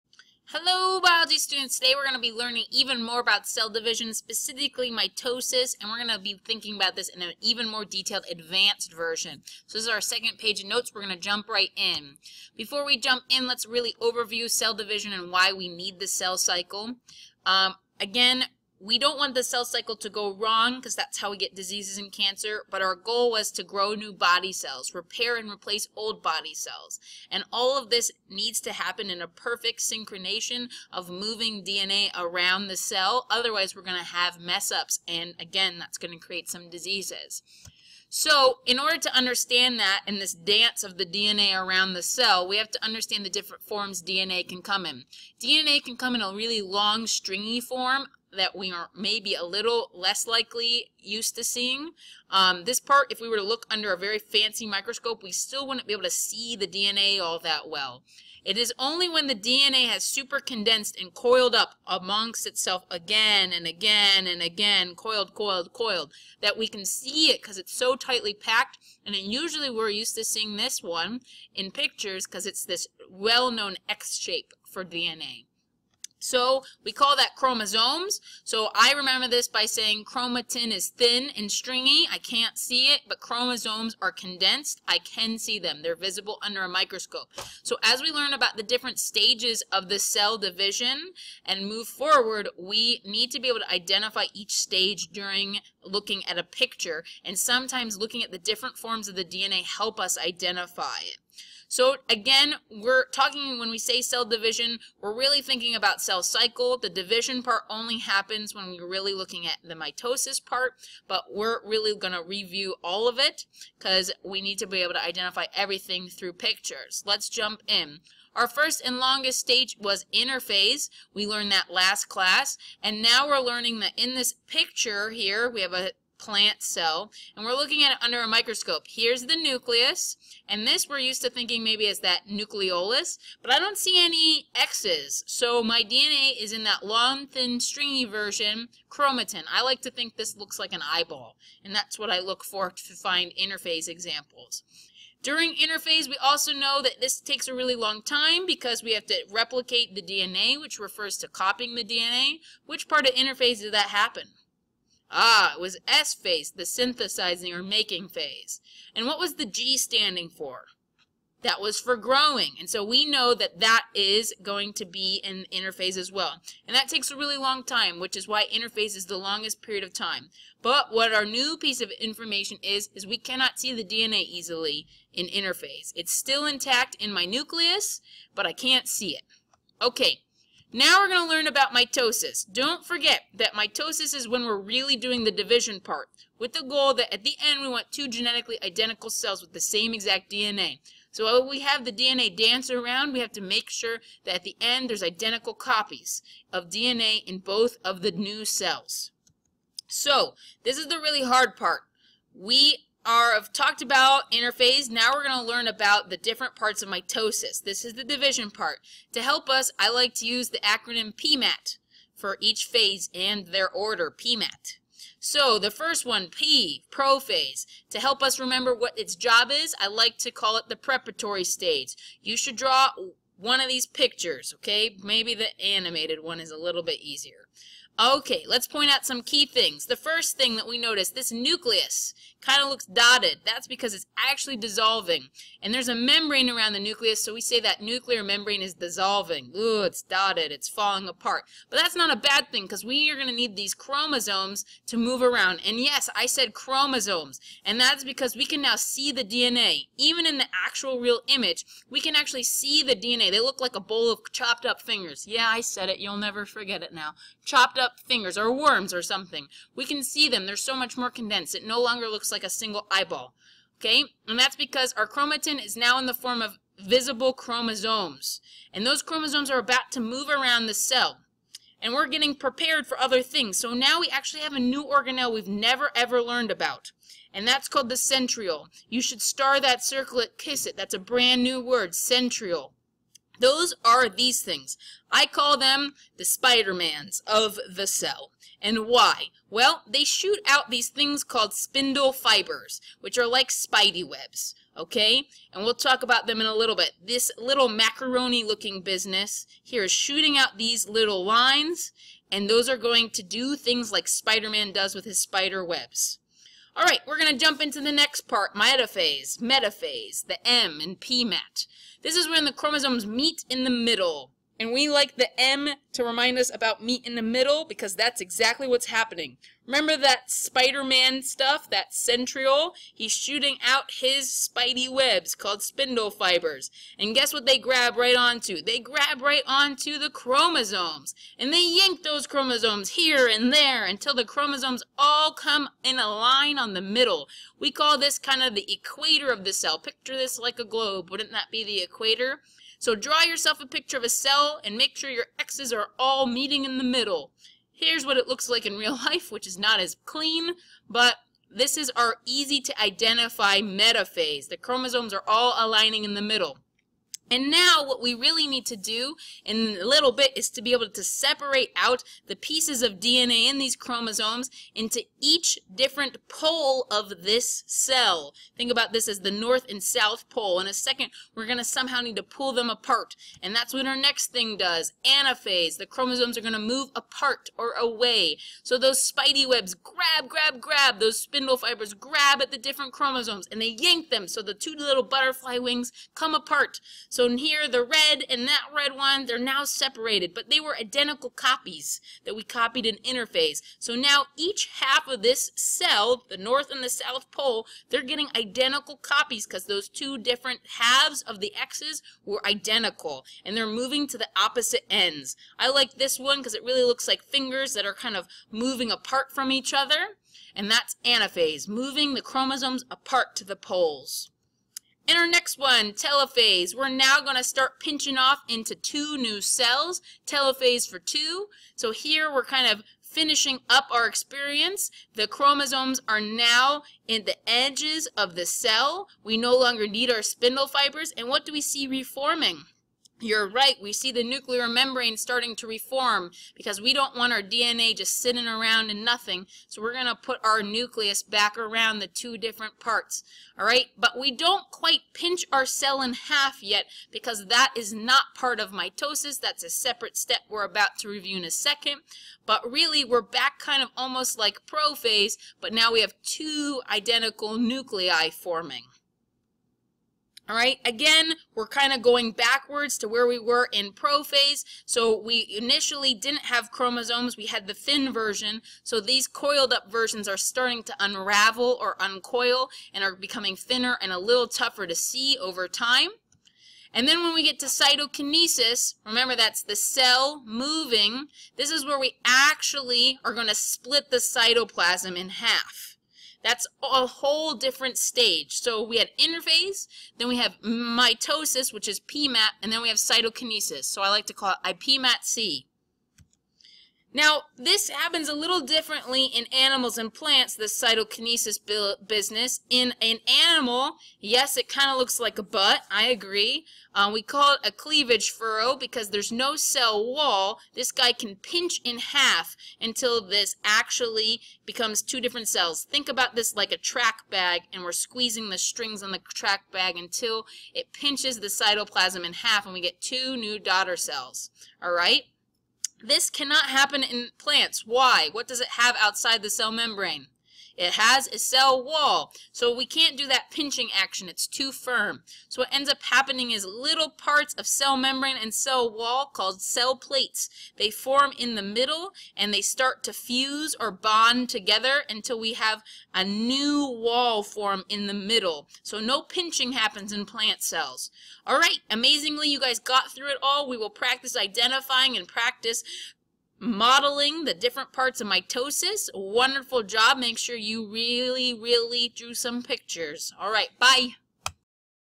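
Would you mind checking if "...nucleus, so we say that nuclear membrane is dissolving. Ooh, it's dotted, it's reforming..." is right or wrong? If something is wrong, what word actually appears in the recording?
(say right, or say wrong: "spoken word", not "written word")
wrong: "falling", not "reforming".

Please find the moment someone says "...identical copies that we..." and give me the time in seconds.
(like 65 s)
390 s.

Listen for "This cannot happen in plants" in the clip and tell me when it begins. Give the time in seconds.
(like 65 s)
526 s.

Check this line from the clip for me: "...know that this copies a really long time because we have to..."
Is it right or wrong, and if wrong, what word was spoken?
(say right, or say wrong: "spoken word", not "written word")
wrong: "takes", not "copies".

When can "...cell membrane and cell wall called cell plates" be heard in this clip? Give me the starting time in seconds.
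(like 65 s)
537 s.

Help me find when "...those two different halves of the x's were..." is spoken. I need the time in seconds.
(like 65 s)
399 s.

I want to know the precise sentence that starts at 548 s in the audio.
So no pinching happens in plant cells.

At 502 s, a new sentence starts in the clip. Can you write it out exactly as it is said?
In an animal, yes, it kind of looks like a butt, I agree.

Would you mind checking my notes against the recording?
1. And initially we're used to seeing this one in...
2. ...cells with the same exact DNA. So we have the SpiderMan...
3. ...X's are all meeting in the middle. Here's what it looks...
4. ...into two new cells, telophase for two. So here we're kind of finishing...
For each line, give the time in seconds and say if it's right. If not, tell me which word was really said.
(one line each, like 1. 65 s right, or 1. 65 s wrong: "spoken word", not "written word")
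1. 69 s wrong: "usually", not "initially"
2. 189 s wrong: "DNA", not "SpiderMan"
3. 345 s right
4. 418 s right.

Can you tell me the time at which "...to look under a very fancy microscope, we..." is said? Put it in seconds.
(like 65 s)
53 s.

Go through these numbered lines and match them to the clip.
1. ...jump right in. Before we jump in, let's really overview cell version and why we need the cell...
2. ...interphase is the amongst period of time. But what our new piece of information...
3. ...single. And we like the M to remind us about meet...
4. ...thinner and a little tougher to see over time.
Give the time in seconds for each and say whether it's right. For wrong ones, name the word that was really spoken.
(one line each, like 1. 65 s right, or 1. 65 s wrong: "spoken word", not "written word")
1. 11 s wrong: "division", not "version"
2. 168 s wrong: "longest", not "amongst"
3. 313 s wrong: "middle", not "single"
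4. 473 s right.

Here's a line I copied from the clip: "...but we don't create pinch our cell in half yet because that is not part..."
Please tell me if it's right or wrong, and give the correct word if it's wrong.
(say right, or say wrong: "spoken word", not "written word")
wrong: "quite", not "create".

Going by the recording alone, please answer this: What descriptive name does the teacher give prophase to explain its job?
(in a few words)
The preparatory stage.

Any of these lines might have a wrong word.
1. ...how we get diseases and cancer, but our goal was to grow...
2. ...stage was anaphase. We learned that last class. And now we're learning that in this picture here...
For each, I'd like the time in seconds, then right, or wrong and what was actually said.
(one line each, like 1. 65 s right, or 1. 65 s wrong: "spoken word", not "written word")
1. 21 s right
2. 119 s wrong: "interphase", not "anaphase".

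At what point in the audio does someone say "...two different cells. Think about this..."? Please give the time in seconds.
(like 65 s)
515 s.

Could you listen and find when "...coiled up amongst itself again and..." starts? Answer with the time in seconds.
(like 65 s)
61 s.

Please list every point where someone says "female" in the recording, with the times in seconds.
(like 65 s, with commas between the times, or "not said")
not said.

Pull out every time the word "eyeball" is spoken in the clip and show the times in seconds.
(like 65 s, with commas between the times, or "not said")
140 s, 262 s.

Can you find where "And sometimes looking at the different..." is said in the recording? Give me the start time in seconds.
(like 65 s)
97 s.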